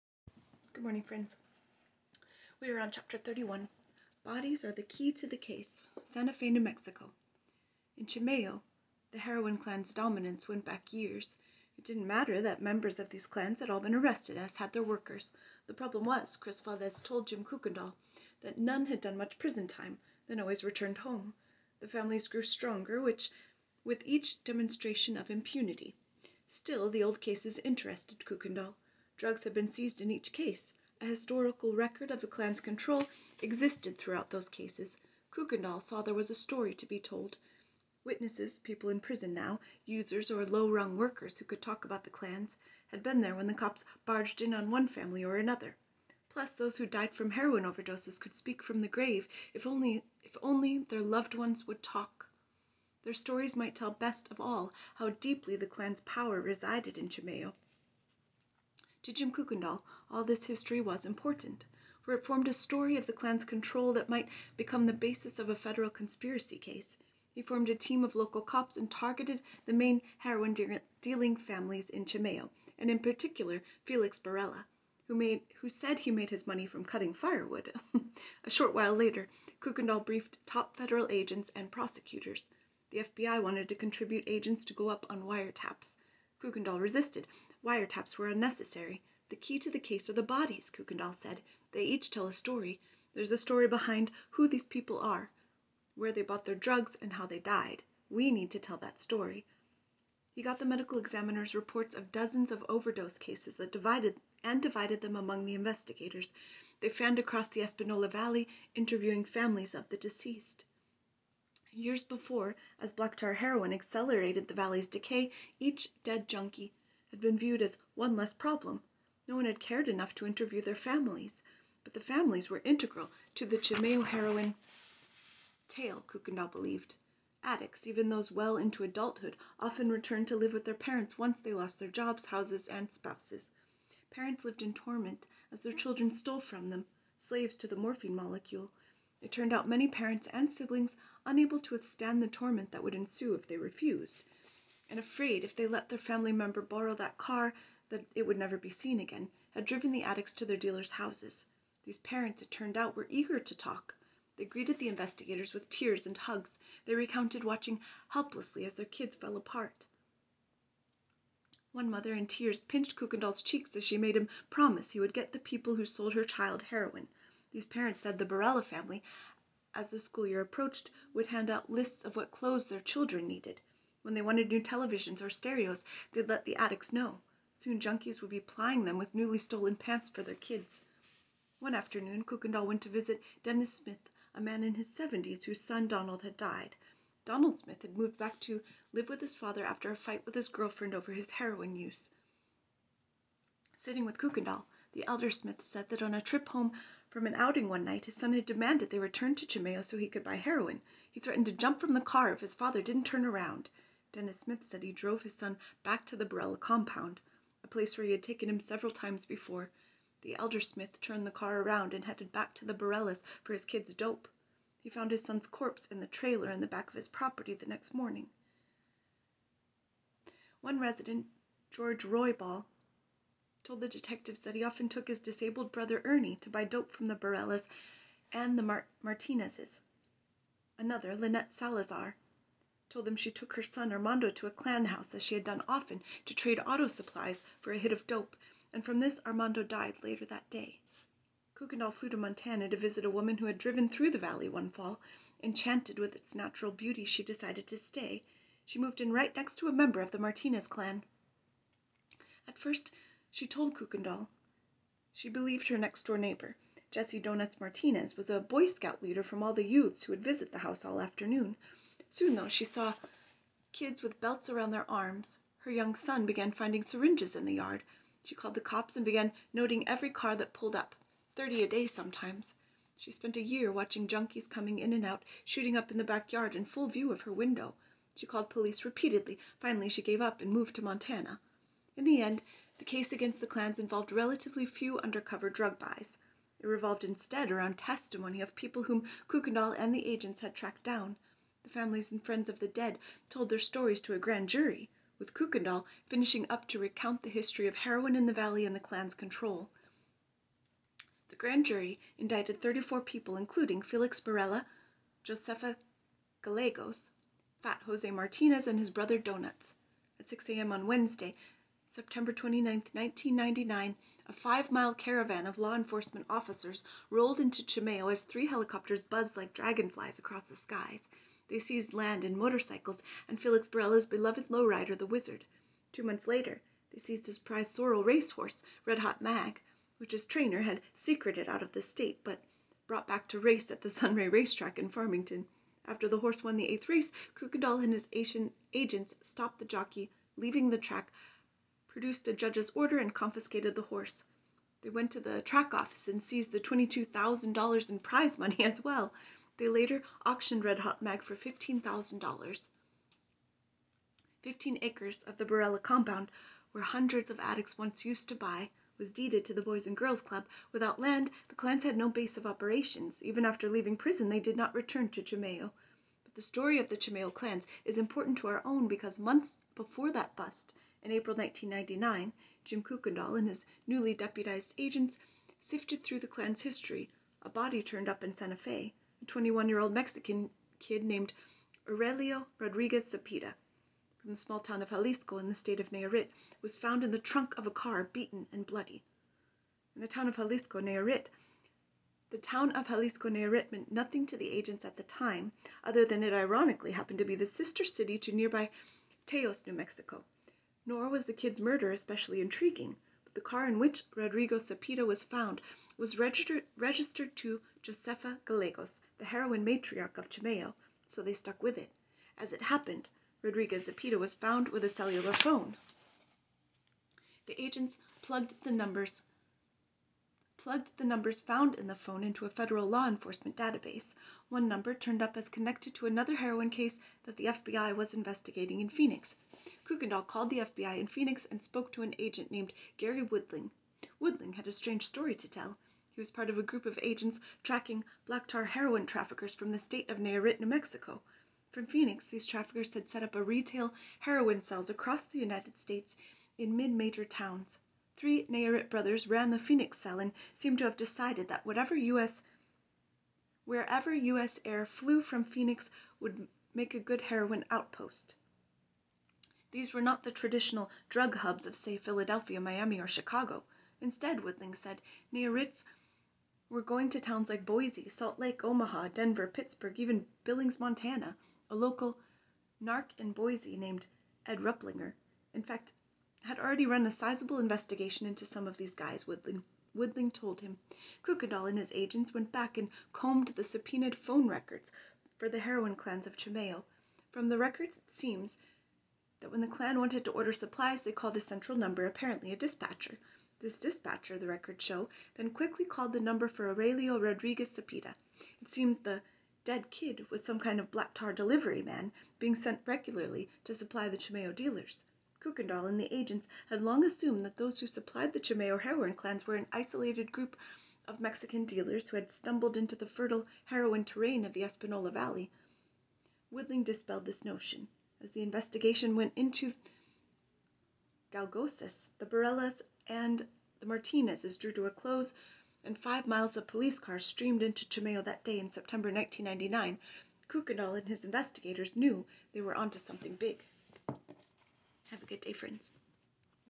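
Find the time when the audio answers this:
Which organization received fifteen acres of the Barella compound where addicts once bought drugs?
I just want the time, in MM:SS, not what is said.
05:59.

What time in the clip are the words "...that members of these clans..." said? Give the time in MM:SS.
00:12.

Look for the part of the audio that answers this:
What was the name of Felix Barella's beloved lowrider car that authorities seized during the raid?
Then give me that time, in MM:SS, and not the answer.
05:24.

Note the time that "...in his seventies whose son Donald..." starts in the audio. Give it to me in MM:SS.
03:04.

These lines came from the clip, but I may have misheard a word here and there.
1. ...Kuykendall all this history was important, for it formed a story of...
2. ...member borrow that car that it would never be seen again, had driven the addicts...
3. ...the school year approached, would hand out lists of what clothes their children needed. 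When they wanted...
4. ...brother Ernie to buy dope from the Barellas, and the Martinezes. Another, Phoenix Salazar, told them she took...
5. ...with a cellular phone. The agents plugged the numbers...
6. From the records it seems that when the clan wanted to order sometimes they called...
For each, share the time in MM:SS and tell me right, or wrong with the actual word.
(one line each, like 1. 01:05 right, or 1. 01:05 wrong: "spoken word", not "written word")
1. 00:59 right
2. 02:26 right
3. 02:49 right
4. 03:45 wrong: "Lynette", not "Phoenix"
5. 06:54 right
6. 08:07 wrong: "supplies", not "sometimes".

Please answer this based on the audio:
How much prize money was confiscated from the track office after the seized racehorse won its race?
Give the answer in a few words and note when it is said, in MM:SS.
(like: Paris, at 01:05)
$22,000, at 05:46.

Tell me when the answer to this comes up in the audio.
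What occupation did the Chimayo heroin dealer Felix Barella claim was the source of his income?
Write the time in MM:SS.
01:16.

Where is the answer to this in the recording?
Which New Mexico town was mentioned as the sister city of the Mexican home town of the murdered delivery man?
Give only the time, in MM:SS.
06:39.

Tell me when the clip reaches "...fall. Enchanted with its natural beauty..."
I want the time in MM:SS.
04:04.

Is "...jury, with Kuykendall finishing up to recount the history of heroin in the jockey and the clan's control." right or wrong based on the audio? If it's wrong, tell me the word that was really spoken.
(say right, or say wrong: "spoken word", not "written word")
wrong: "valley", not "jockey".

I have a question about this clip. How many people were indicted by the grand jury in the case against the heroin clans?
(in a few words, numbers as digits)
34.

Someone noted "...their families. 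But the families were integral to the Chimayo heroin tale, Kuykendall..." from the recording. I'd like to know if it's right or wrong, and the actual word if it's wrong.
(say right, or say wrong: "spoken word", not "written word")
right.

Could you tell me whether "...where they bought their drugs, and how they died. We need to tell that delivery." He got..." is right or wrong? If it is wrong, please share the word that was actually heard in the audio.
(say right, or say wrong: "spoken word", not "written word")
wrong: "story", not "delivery".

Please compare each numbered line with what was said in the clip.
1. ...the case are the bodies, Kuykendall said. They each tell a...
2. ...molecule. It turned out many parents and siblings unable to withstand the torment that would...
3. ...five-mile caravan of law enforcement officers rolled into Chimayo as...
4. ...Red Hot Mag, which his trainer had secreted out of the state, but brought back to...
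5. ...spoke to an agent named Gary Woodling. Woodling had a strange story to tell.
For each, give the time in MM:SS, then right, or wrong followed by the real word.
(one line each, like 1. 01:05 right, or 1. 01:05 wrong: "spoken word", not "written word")
1. 01:29 right
2. 02:18 right
3. 05:14 right
4. 05:28 right
5. 07:11 right.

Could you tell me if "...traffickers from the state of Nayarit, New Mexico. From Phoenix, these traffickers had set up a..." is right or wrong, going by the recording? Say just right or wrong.
right.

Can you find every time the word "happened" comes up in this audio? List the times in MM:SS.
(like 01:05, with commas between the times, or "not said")
06:36, 06:52.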